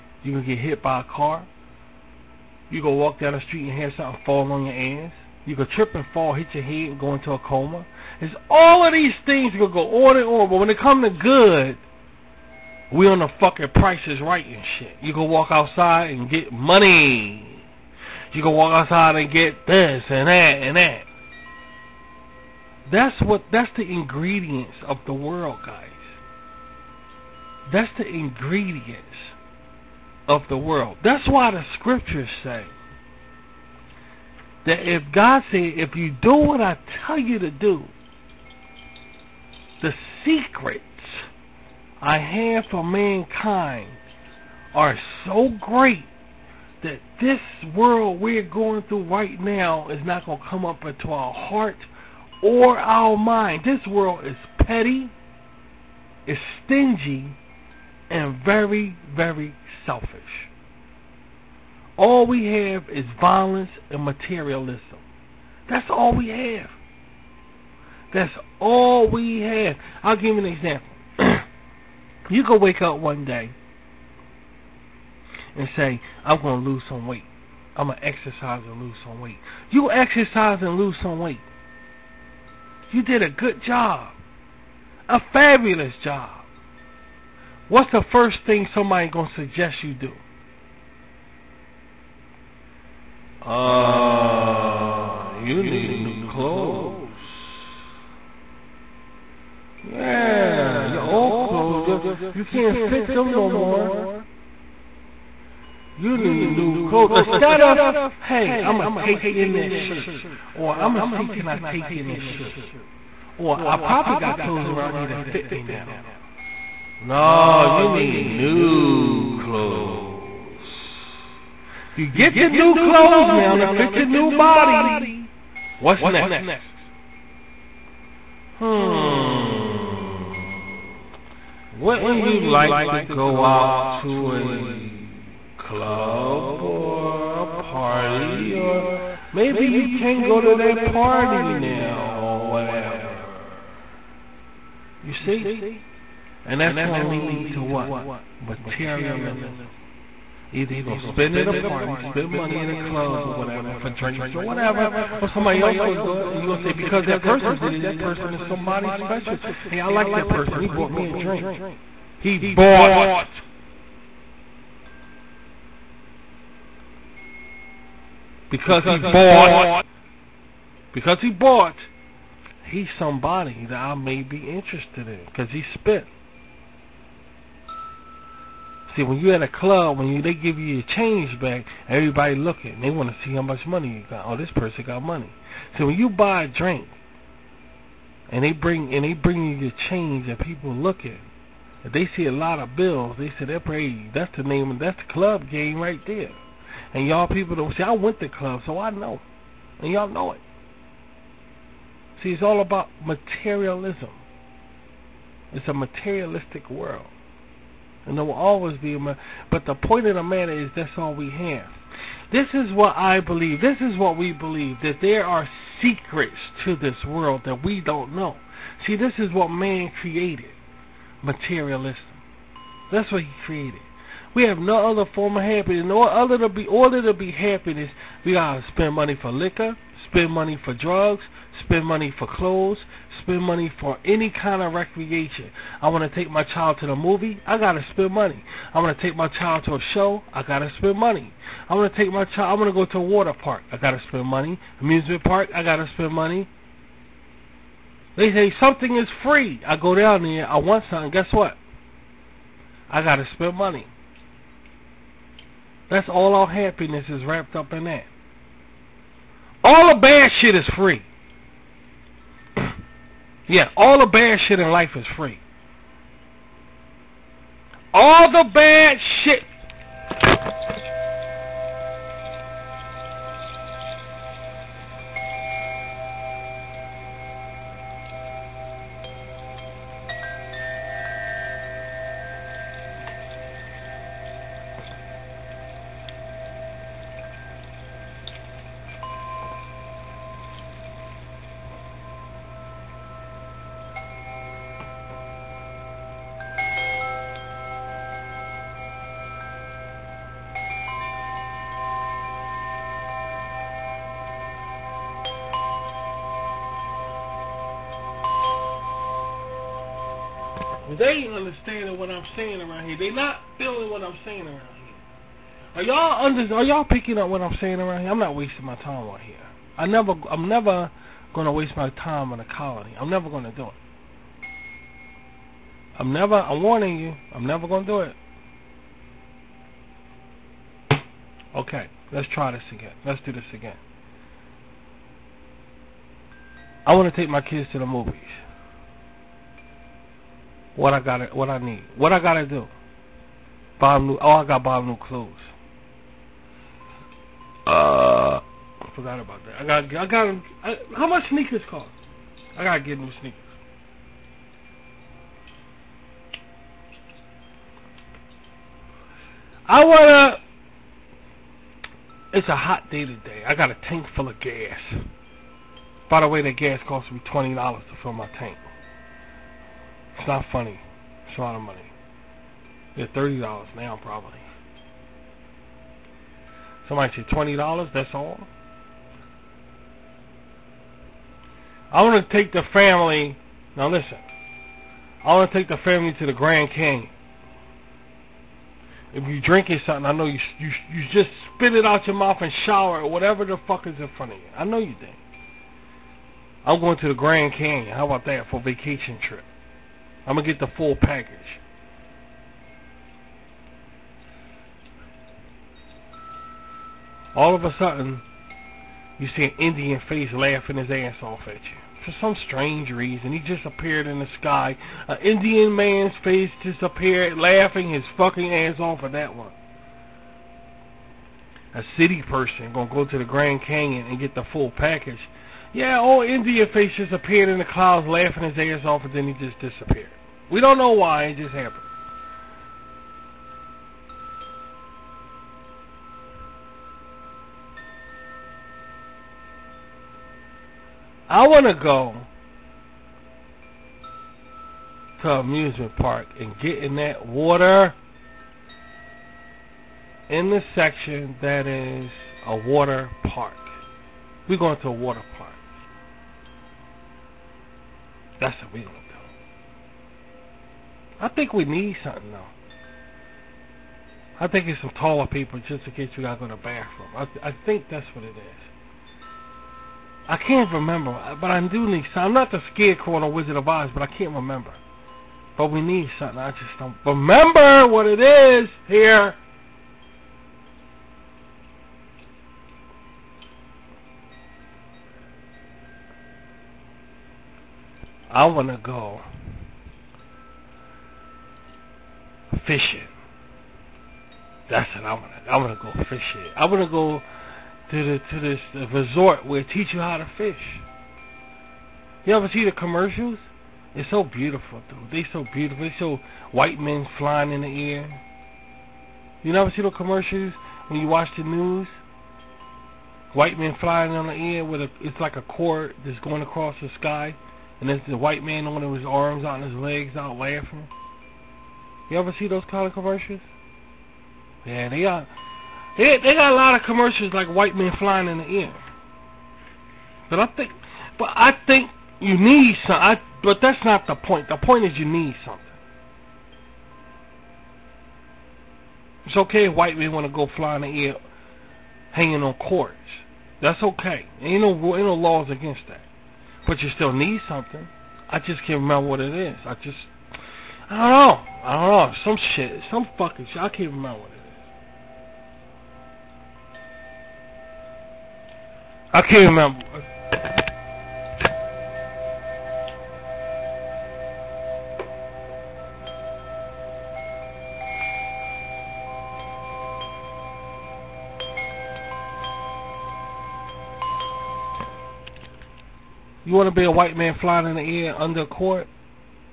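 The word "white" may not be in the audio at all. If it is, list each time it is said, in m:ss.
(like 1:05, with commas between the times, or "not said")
8:26, 8:33, 8:38, 8:47, 8:59, 9:36.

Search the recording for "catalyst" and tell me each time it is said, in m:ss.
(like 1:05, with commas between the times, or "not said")
not said.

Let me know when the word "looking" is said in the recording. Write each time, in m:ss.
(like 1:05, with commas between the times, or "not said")
3:02, 3:10.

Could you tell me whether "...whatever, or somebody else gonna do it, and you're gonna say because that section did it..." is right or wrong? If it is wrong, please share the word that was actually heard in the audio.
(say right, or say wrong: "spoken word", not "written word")
wrong: "person", not "section".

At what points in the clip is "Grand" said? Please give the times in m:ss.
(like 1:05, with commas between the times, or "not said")
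6:26, 6:37, 7:03.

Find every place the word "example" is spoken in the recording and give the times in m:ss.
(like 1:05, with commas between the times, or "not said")
1:10.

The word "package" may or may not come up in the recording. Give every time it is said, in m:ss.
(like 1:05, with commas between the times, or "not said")
6:41, 7:04.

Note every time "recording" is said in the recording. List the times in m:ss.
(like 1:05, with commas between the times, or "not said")
not said.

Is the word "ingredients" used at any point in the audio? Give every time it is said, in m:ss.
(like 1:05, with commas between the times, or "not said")
0:23, 0:28.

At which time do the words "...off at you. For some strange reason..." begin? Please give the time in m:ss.
6:51.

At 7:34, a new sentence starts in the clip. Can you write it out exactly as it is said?
We're going to a water park.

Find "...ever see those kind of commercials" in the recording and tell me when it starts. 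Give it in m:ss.
8:42.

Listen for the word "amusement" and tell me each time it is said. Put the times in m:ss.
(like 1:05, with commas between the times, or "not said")
4:04, 7:25.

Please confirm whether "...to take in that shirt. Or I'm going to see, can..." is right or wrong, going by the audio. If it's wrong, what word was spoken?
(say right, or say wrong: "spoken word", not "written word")
right.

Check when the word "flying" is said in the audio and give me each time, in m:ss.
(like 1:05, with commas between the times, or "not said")
8:27, 8:33, 8:47, 9:37.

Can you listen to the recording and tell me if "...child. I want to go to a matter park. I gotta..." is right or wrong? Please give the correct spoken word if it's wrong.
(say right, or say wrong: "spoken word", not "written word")
wrong: "water", not "matter".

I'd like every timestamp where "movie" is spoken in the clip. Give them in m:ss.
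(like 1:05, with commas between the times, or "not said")
3:56, 5:37.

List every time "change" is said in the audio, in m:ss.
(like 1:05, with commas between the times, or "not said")
3:00, 3:09.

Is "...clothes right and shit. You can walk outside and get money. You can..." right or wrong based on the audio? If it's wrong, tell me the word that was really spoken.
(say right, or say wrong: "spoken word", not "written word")
wrong: "prices", not "clothes".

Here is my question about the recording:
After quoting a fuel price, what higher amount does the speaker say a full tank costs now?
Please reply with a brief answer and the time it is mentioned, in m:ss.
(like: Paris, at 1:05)
$30, at 6:13.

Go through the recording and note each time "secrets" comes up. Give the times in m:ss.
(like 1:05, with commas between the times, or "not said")
0:40, 3:35.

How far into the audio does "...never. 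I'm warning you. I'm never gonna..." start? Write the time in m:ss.
5:26.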